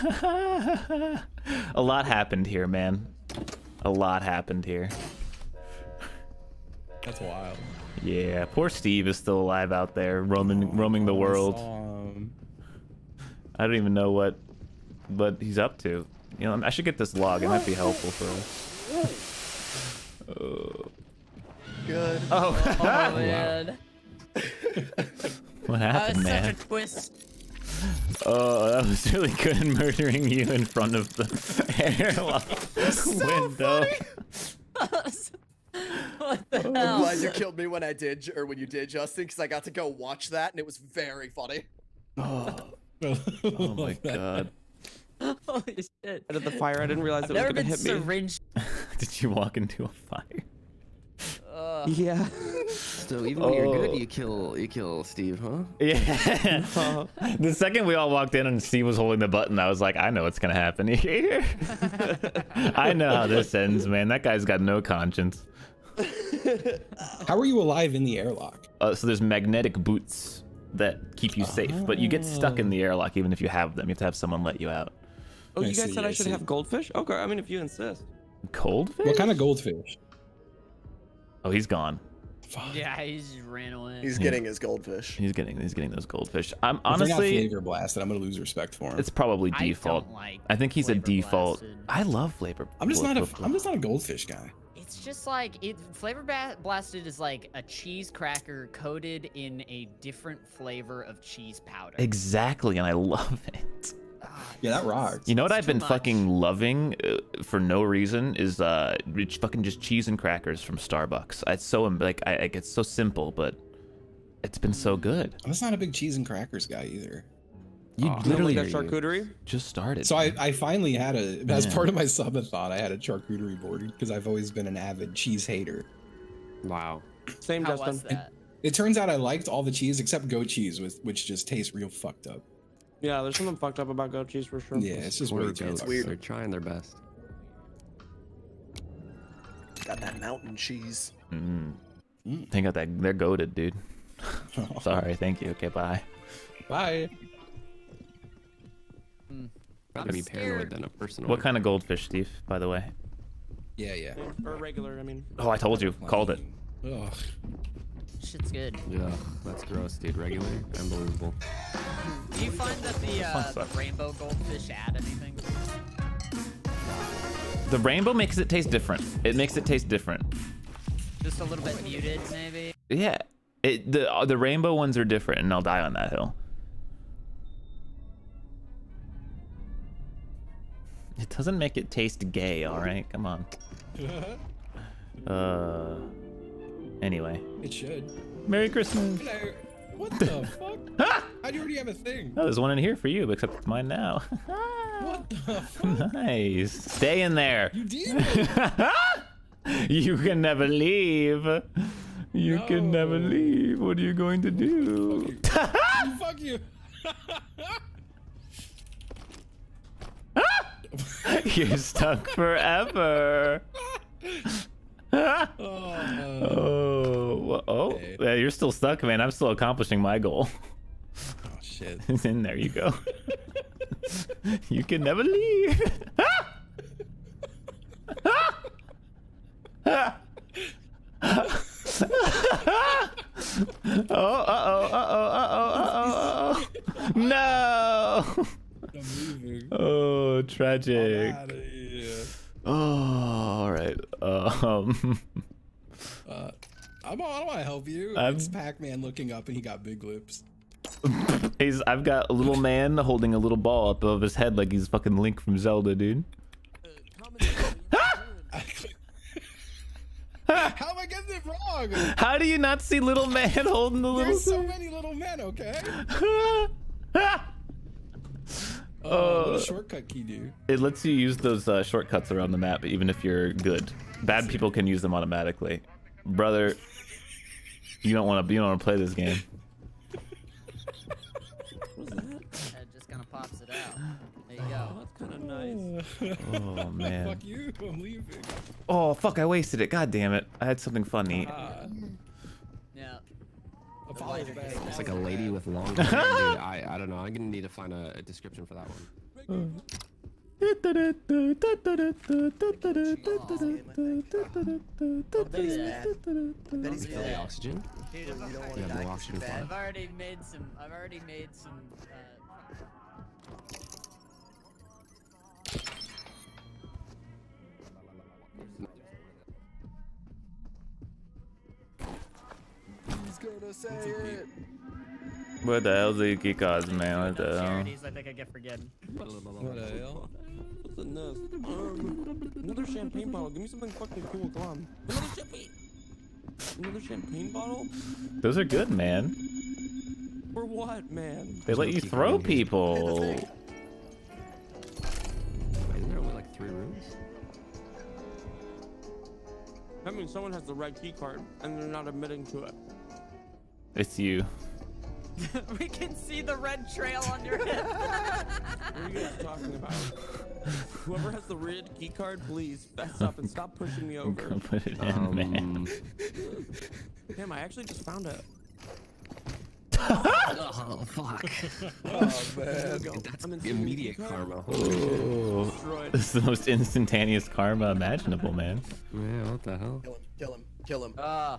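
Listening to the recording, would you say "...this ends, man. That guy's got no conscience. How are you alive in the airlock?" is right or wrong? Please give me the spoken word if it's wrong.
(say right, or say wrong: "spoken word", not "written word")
right.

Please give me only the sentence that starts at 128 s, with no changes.
It, it turns out I liked all the cheese except goat cheese, with, which just tastes real fucked up.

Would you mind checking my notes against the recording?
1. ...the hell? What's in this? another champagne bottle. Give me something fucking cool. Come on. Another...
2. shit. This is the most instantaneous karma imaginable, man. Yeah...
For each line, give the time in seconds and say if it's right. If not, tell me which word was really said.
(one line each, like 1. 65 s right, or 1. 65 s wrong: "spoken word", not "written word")
1. 329 s right
2. 374 s right.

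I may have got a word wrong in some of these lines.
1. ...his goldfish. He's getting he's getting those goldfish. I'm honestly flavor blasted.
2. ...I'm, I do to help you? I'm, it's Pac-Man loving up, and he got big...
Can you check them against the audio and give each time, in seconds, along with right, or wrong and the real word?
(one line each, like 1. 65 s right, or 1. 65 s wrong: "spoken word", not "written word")
1. 84 s right
2. 247 s wrong: "looking", not "loving".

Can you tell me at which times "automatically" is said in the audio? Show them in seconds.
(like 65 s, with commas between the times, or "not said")
275 s.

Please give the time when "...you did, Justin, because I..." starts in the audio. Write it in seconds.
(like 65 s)
38 s.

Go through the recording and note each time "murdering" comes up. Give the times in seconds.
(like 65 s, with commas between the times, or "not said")
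29 s.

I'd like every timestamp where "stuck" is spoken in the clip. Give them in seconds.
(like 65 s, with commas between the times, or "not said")
72 s, 211 s, 218 s.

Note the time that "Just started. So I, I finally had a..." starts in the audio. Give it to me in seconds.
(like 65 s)
119 s.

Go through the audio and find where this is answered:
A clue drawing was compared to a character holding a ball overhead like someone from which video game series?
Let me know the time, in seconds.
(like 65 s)
255 s.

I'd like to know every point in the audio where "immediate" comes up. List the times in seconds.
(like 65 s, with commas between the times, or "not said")
373 s.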